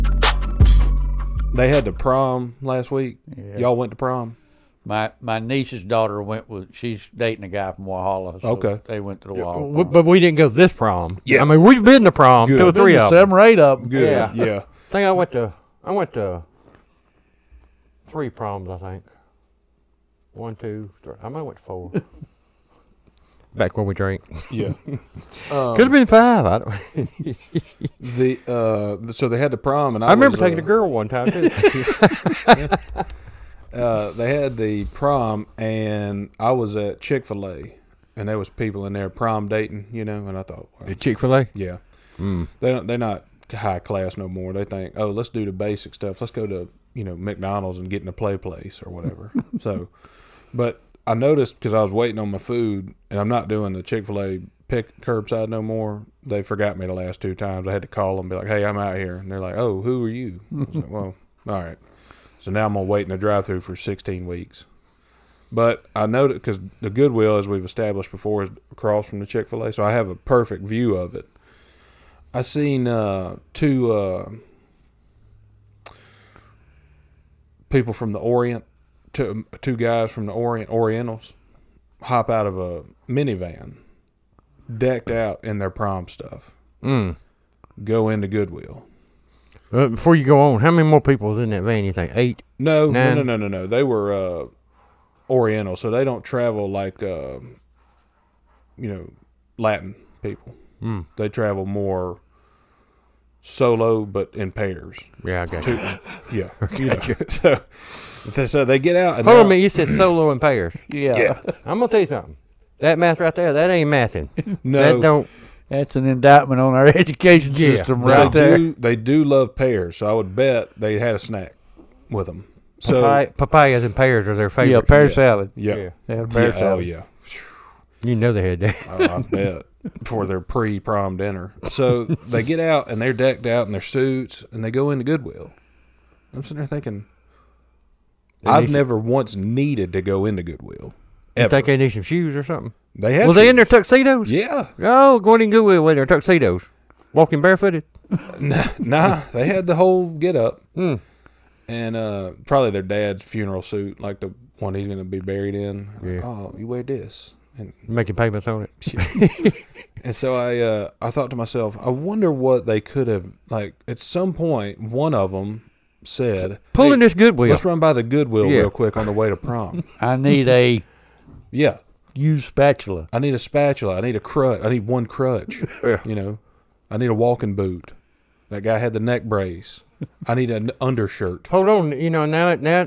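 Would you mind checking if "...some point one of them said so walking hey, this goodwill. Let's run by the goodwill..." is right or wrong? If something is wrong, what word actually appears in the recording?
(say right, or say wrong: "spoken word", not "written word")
wrong: "pulling", not "walking".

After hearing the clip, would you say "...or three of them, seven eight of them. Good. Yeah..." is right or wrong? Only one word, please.
right.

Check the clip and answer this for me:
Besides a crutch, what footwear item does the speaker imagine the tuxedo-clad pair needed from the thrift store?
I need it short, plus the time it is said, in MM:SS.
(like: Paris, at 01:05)
walking boot, at 02:57.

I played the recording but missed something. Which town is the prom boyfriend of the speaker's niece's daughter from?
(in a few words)
Walhalla.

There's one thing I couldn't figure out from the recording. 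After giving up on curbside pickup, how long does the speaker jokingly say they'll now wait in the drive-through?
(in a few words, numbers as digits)
16 weeks.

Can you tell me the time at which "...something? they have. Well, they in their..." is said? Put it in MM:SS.
02:22.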